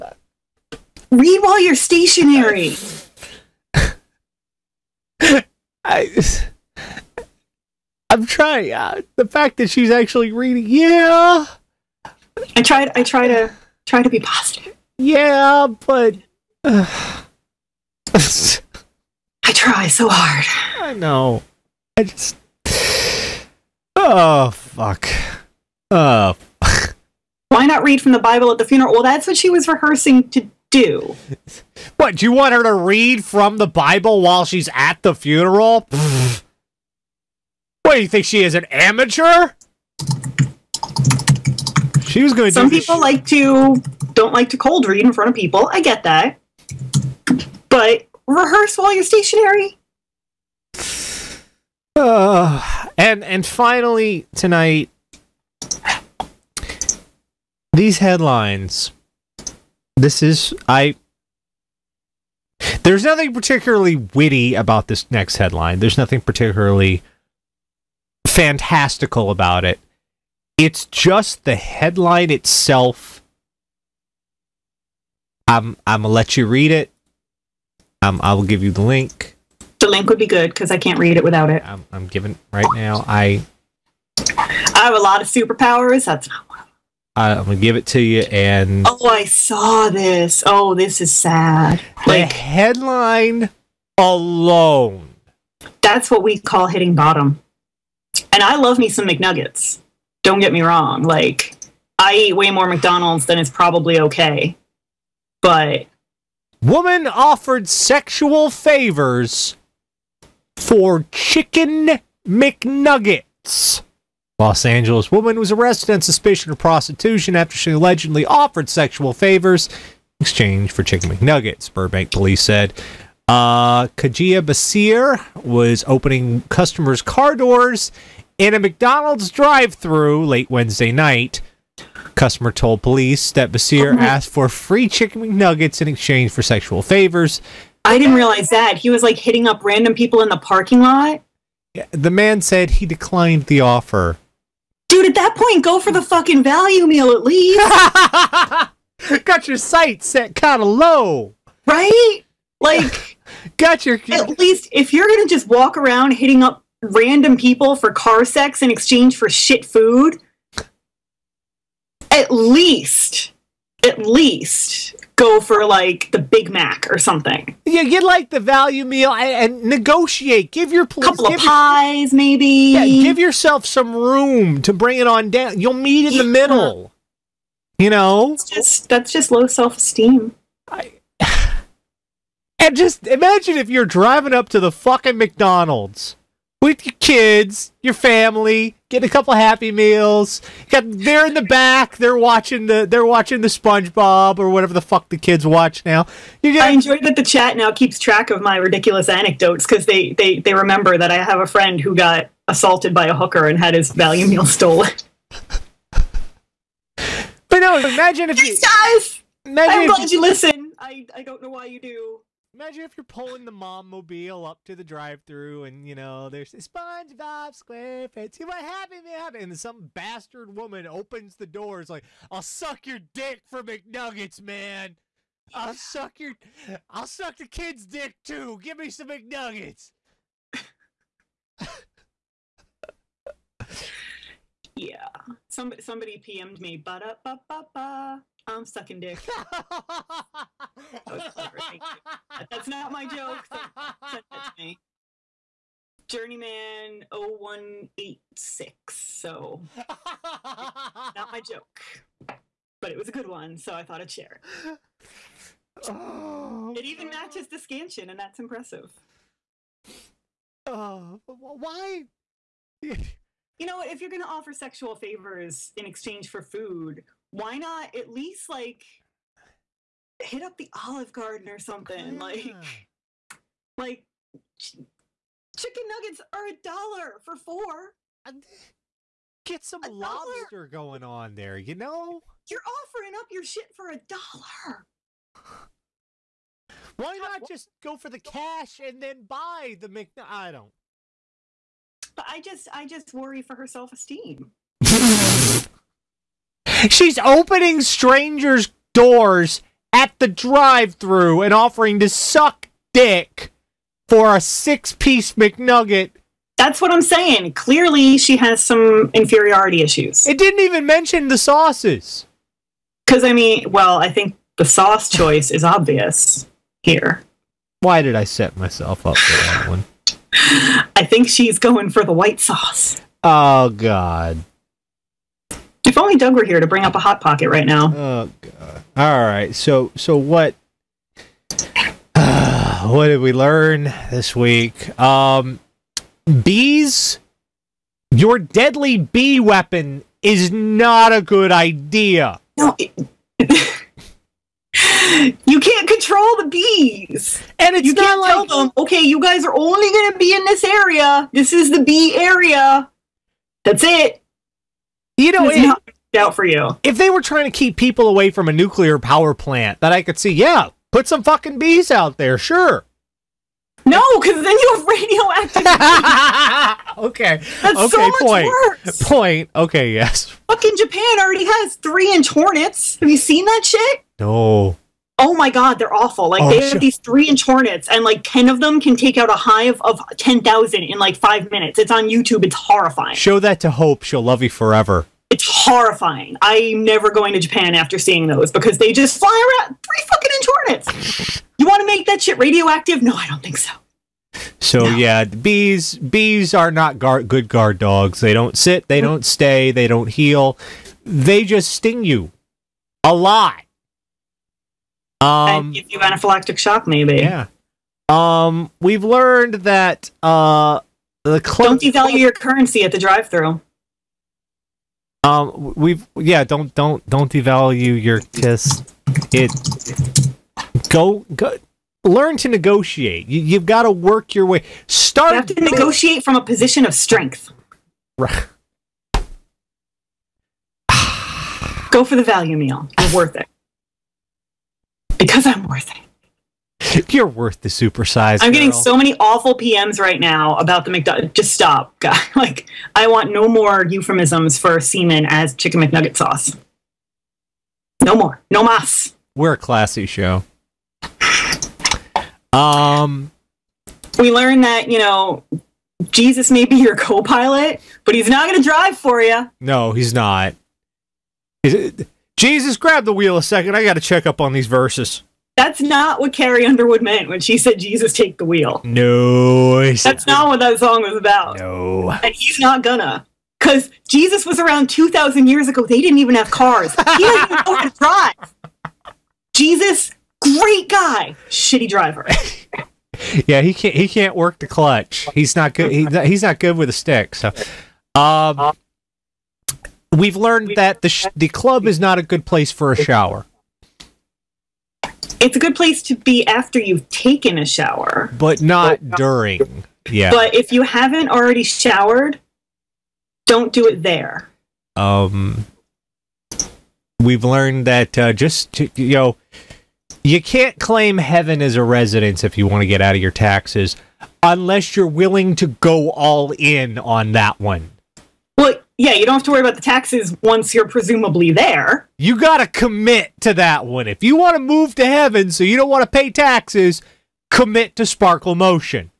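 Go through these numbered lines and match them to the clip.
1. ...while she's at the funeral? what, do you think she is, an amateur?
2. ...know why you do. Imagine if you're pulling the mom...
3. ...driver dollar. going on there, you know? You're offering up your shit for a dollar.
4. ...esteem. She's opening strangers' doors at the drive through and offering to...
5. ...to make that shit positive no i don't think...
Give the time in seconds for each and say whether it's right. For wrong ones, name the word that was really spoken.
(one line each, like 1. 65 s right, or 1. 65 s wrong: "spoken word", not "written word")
1. 34 s right
2. 211 s right
3. 279 s wrong: "lobster", not "driver"
4. 293 s right
5. 391 s wrong: "radioactive", not "positive".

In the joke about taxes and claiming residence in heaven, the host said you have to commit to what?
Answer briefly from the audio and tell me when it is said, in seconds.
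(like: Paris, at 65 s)
Sparkle Motion, at 528 s.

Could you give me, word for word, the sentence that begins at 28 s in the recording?
Well, that's what she was rehearsing to do.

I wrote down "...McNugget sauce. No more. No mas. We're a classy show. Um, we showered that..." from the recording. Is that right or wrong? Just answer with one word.
wrong.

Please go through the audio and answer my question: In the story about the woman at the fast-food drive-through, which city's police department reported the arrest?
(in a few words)
Burbank.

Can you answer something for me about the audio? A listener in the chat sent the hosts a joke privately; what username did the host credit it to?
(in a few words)
Journeyman 0186.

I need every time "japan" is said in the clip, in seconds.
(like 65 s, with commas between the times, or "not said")
370 s, 387 s.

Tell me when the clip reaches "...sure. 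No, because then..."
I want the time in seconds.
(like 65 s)
362 s.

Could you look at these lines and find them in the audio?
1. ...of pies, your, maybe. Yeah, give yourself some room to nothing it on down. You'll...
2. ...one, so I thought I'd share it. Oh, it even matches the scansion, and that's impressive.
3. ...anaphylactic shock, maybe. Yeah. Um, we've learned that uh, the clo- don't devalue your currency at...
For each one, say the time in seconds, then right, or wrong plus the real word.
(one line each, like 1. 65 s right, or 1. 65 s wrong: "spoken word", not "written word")
1. 171 s wrong: "bring", not "nothing"
2. 253 s right
3. 405 s right.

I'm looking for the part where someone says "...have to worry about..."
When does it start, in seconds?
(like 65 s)
519 s.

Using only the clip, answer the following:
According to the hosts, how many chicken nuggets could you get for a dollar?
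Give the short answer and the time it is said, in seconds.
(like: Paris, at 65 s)
4, at 276 s.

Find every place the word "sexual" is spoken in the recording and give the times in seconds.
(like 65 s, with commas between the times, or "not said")
107 s, 118 s, 136 s, 264 s.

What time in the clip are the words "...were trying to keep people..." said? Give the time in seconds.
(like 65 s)
357 s.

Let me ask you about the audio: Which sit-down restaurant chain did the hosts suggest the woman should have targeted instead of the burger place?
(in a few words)
Olive Garden.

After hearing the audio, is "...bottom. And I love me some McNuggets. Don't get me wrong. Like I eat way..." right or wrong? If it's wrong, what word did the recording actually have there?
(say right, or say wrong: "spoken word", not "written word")
right.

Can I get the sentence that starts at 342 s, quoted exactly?
No, it, you can't control the bees.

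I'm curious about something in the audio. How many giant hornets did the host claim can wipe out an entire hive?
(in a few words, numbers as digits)
10.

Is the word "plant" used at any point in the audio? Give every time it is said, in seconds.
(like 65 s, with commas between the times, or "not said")
359 s.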